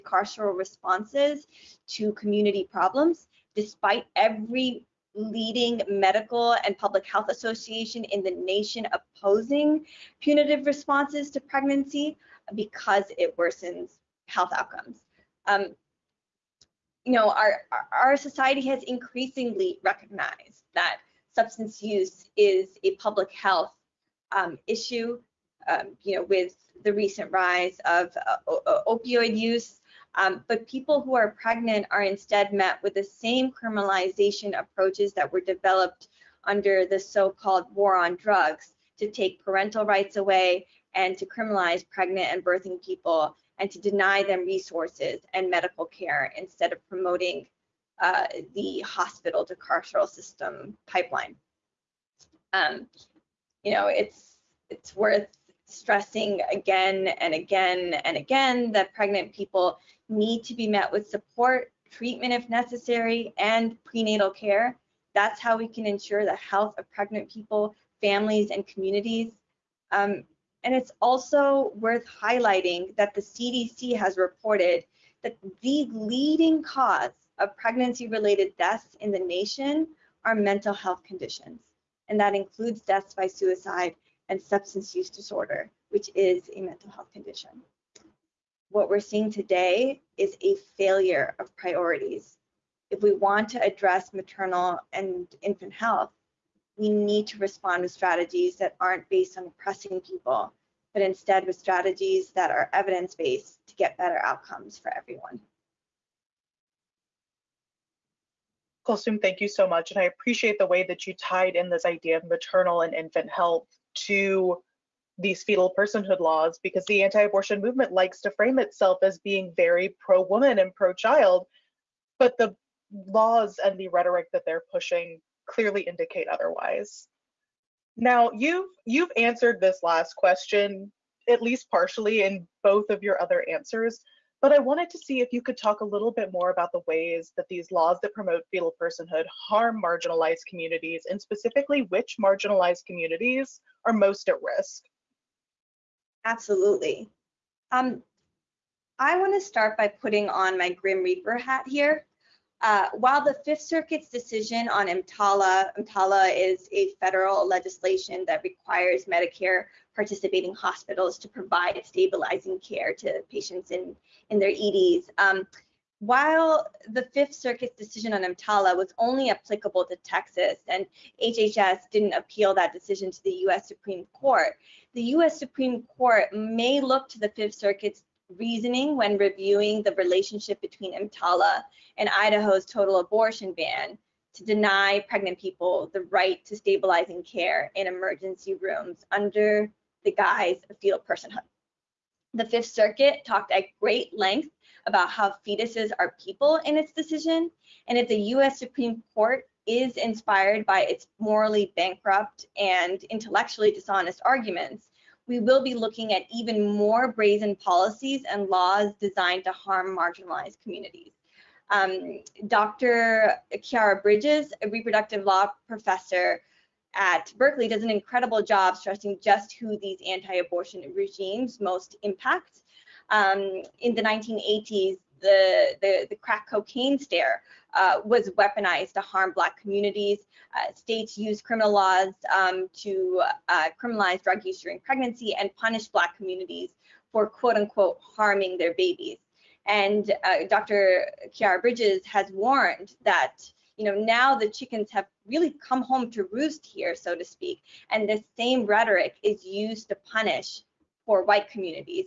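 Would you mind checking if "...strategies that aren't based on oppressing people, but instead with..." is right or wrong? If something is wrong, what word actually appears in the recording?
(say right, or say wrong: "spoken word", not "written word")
right.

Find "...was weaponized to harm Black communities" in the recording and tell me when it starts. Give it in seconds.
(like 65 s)
228 s.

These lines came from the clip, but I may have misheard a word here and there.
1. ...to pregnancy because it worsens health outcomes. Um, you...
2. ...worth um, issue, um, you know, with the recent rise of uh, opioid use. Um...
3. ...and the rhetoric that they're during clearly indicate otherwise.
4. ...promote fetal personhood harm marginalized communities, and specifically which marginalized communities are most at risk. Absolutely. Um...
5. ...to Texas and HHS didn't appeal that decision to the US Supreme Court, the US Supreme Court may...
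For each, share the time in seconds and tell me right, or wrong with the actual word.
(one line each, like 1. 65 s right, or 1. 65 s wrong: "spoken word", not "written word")
1. 11 s right
2. 23 s wrong: "health", not "worth"
3. 123 s wrong: "pushing", not "during"
4. 138 s right
5. 169 s right.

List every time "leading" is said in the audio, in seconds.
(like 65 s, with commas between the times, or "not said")
5 s, 75 s.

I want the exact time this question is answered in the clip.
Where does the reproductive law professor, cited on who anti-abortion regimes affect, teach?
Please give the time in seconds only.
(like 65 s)
217 s.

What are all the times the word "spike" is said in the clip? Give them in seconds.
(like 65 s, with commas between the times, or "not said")
not said.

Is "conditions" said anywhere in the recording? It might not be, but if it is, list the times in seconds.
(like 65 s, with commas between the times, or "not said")
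81 s, 87 s.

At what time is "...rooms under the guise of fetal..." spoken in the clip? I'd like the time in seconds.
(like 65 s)
188 s.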